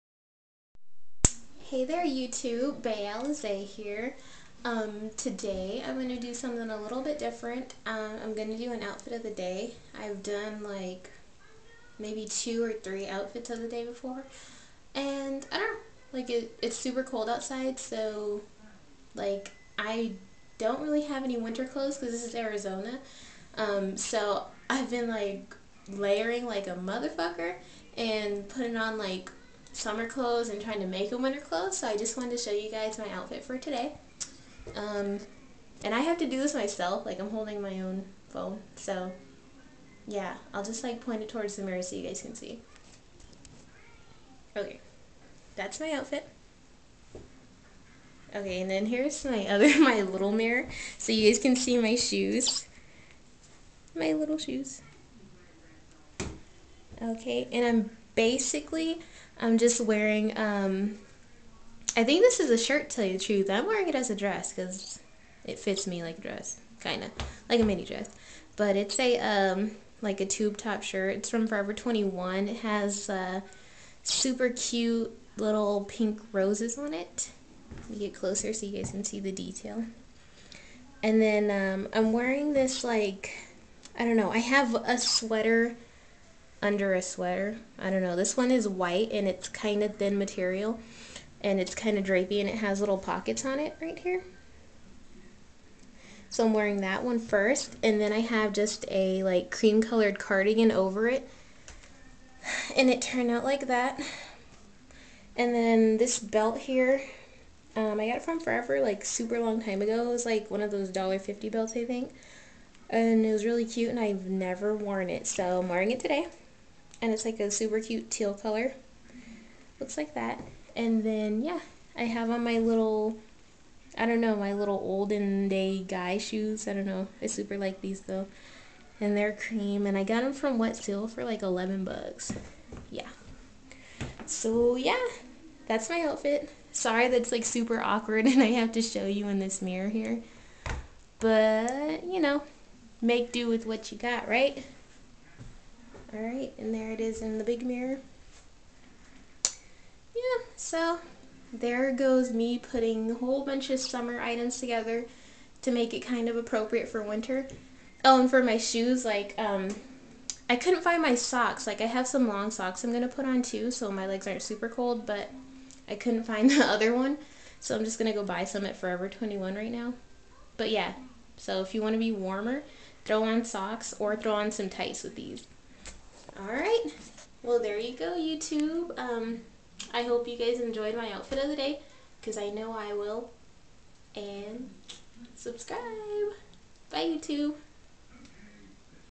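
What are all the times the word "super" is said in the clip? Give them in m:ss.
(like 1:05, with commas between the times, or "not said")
0:16, 1:14, 1:49, 1:57, 2:07, 2:17, 2:44.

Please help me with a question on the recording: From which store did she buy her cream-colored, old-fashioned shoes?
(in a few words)
Wet Seal.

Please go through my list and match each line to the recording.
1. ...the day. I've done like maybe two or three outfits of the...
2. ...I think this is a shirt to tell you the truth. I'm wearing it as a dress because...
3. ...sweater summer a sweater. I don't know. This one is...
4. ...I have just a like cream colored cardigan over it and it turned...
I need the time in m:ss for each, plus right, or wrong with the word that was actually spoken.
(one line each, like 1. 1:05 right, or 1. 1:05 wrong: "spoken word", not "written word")
1. 0:09 right
2. 1:01 right
3. 1:24 wrong: "under", not "summer"
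4. 1:38 right.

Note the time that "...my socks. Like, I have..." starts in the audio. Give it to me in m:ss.
2:41.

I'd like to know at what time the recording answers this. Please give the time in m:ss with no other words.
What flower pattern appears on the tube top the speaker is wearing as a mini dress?
1:15.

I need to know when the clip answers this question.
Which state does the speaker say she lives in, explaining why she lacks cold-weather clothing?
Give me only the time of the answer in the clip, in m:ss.
0:22.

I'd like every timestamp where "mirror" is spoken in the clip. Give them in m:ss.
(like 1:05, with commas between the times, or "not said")
0:41, 0:50, 2:19, 2:27.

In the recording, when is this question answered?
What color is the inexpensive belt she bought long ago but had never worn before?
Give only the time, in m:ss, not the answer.
1:58.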